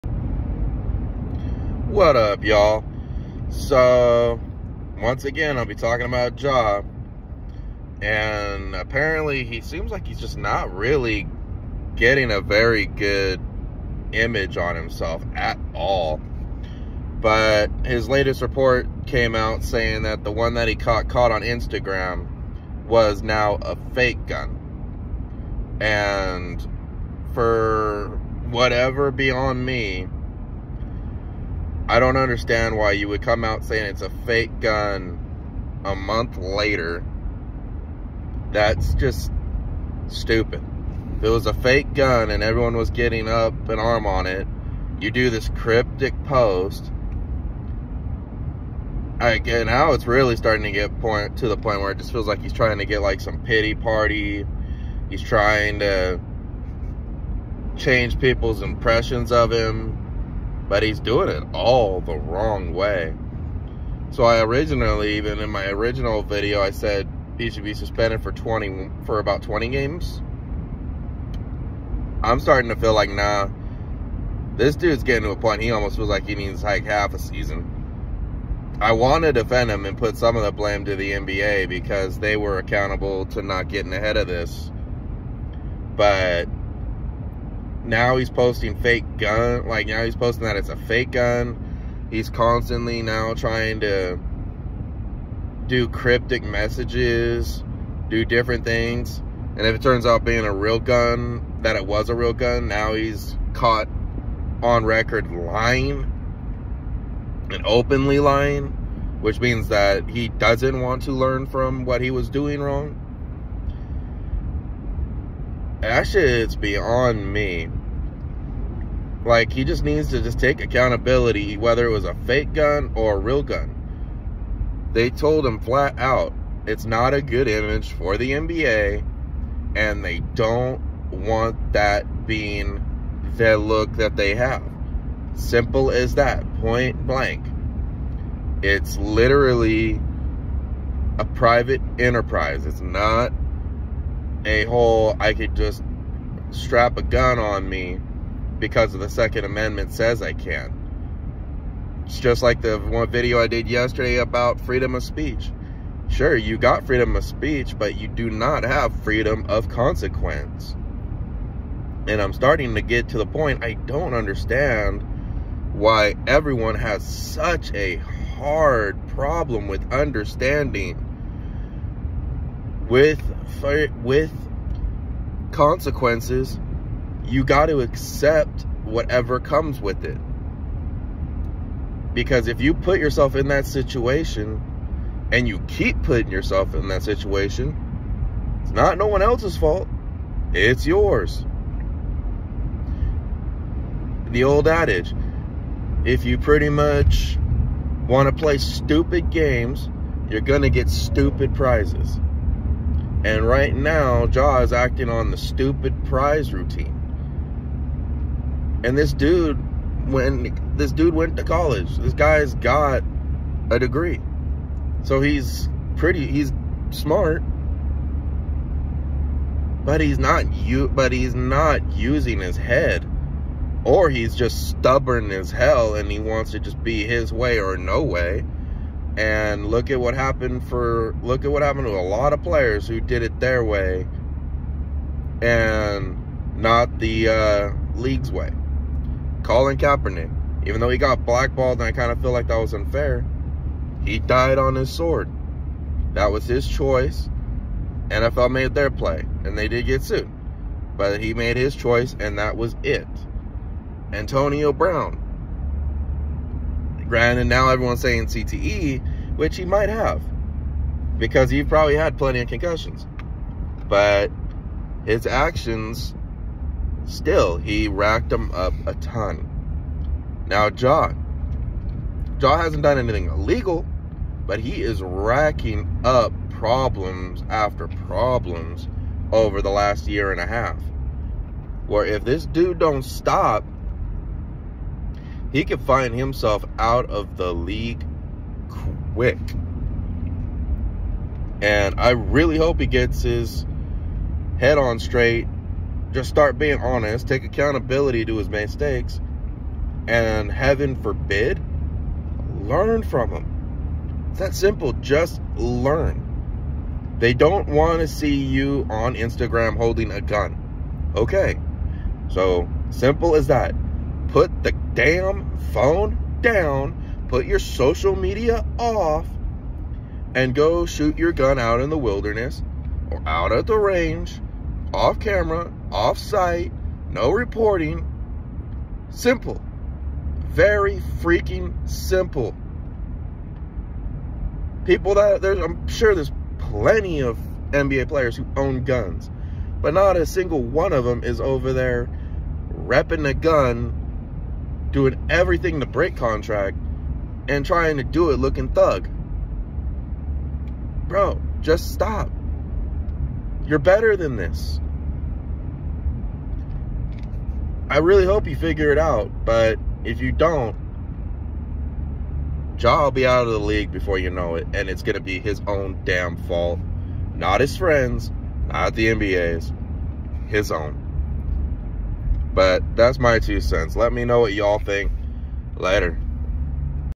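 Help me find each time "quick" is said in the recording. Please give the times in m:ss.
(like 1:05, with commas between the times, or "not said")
4:49.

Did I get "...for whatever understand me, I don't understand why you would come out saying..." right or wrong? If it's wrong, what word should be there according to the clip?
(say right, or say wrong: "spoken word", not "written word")
wrong: "beyond", not "understand".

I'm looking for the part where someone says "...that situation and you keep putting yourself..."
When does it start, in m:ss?
3:03.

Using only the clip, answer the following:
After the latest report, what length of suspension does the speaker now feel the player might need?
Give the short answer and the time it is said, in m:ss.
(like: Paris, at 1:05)
half a season, at 1:16.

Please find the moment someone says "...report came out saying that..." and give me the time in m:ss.
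0:18.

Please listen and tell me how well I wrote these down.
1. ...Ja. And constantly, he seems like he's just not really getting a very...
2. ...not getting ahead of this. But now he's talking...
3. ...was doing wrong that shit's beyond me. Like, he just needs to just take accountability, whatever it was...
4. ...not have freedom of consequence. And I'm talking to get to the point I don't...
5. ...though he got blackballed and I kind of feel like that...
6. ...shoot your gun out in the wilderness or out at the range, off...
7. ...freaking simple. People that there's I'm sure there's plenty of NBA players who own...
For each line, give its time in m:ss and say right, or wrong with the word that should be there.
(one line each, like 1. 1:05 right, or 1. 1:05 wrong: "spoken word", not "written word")
1. 0:06 wrong: "apparently", not "constantly"
2. 1:23 wrong: "posting", not "talking"
3. 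1:52 wrong: "whether", not "whatever"
4. 2:38 wrong: "starting", not "talking"
5. 4:00 right
6. 5:20 right
7. 5:31 right.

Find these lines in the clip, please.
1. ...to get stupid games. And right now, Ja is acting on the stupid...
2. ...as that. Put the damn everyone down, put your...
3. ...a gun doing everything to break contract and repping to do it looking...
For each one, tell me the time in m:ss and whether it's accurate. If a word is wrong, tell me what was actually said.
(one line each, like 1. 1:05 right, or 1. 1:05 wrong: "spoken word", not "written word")
1. 3:20 wrong: "prizes", not "games"
2. 5:13 wrong: "phone", not "everyone"
3. 5:43 wrong: "trying", not "repping".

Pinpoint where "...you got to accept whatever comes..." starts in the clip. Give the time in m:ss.
2:57.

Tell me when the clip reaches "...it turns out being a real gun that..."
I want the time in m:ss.
1:39.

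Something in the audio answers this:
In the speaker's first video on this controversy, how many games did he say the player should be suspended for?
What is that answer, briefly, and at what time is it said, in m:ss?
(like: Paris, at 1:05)
20, at 1:09.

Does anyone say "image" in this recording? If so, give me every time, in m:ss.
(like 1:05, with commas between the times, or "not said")
0:14, 2:07.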